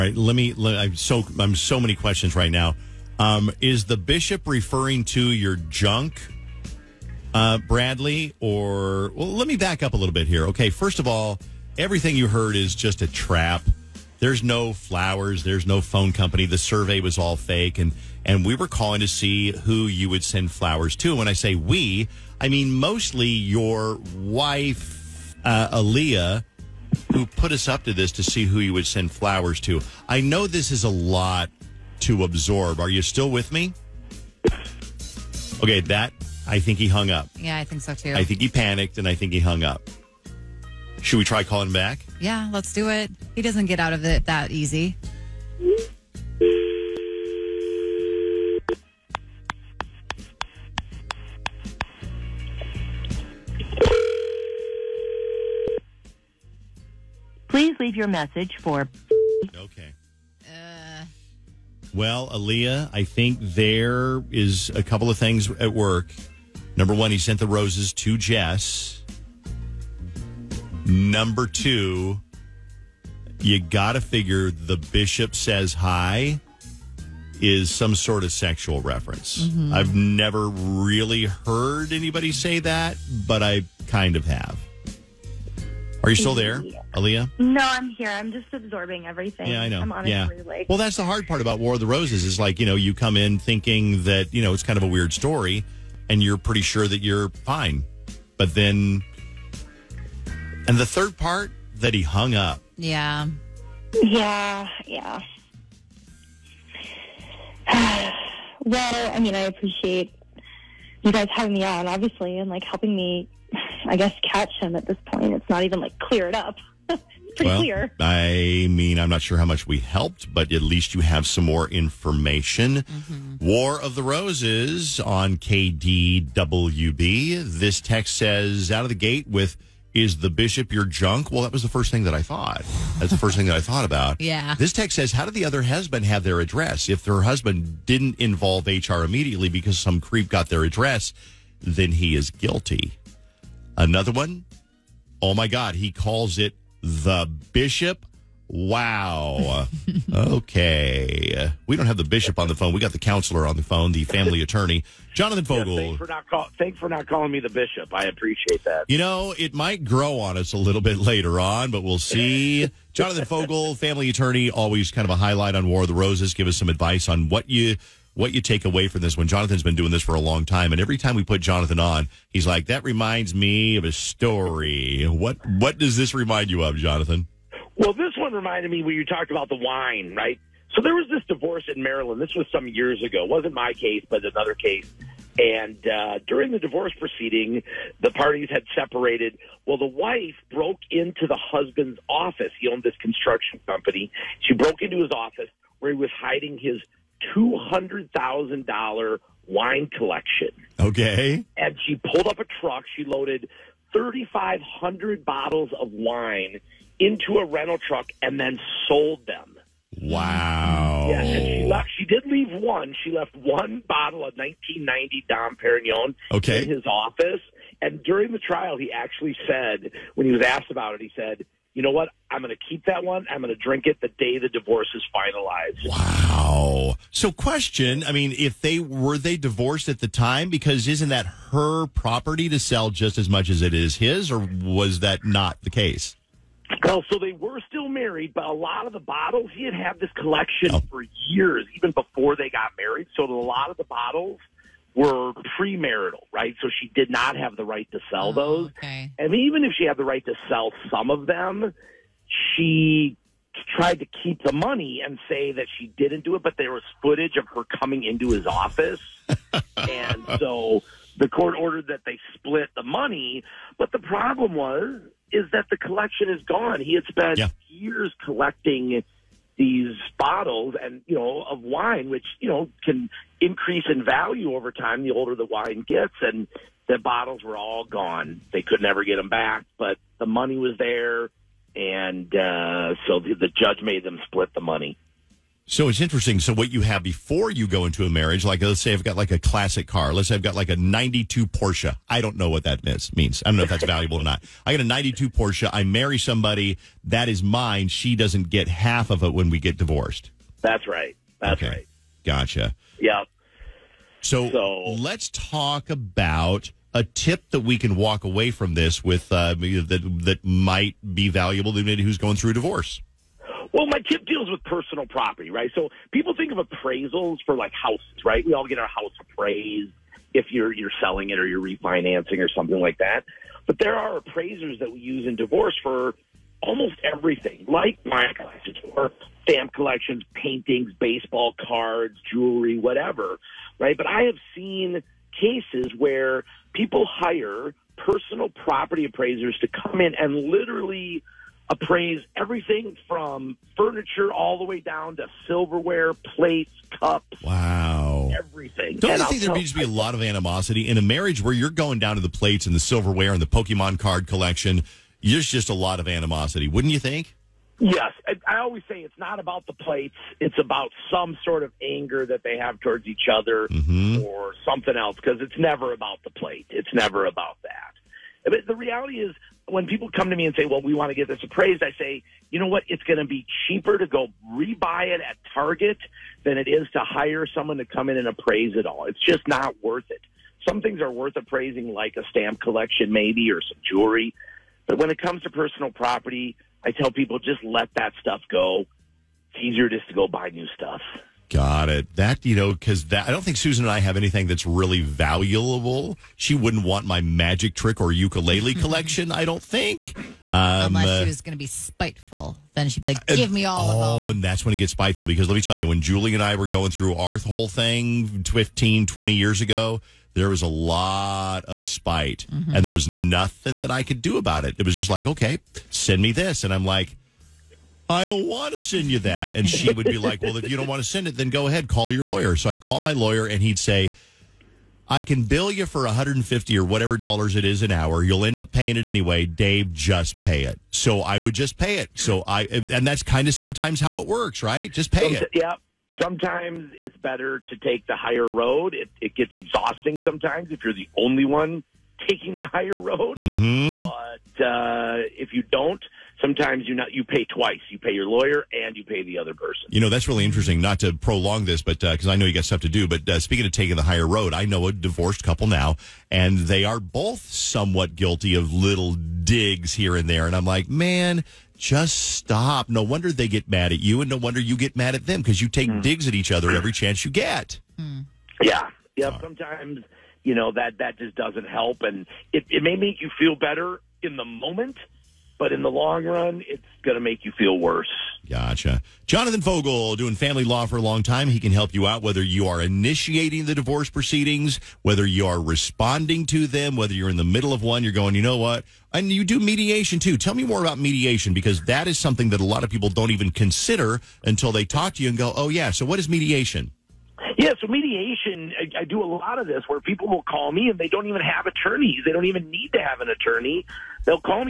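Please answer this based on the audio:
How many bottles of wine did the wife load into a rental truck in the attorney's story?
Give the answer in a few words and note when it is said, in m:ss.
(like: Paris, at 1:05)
3,500, at 3:23.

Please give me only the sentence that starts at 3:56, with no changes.
Well, so they were still married, but a lot of the bottles, he had had this collection oh.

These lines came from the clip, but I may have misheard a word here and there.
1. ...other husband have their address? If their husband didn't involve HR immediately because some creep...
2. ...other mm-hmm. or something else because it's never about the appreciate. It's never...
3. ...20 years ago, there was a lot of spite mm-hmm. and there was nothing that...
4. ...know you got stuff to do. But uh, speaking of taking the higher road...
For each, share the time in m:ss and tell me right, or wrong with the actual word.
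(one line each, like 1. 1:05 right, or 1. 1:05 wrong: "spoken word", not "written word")
1. 2:15 right
2. 6:03 wrong: "plate", not "appreciate"
3. 6:49 right
4. 7:32 right.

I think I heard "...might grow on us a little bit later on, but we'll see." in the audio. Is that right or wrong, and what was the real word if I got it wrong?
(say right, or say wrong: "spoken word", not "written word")
right.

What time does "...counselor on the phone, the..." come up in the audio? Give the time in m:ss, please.
2:32.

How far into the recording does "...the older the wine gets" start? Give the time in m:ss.
4:35.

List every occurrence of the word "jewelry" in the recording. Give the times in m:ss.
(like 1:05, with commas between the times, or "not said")
5:32, 6:23.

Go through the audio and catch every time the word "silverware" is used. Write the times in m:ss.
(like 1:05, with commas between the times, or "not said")
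5:45, 5:52.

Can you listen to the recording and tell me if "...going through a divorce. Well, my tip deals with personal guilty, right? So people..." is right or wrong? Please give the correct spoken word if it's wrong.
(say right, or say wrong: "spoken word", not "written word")
wrong: "property", not "guilty".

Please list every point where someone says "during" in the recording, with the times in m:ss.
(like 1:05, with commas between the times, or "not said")
3:06, 3:38.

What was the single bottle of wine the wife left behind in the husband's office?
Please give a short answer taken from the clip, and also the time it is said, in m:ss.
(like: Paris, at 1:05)
1990 Dom Perignon, at 3:34.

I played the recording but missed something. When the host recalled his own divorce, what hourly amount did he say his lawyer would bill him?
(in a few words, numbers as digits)
$150.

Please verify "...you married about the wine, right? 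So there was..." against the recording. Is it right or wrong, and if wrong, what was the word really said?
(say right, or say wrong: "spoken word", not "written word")
wrong: "talked", not "married".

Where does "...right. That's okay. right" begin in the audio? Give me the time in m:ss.
5:00.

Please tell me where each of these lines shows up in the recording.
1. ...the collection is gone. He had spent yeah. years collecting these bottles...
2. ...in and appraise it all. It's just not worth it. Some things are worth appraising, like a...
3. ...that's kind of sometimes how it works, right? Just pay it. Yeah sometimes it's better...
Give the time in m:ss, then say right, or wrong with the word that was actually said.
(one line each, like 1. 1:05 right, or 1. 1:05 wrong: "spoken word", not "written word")
1. 4:25 right
2. 6:18 right
3. 7:13 right.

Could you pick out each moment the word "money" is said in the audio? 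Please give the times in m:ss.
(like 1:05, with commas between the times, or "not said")
4:14, 4:22, 4:40, 4:44.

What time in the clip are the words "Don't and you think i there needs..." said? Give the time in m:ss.
5:48.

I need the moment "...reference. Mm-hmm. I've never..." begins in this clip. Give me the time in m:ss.
1:18.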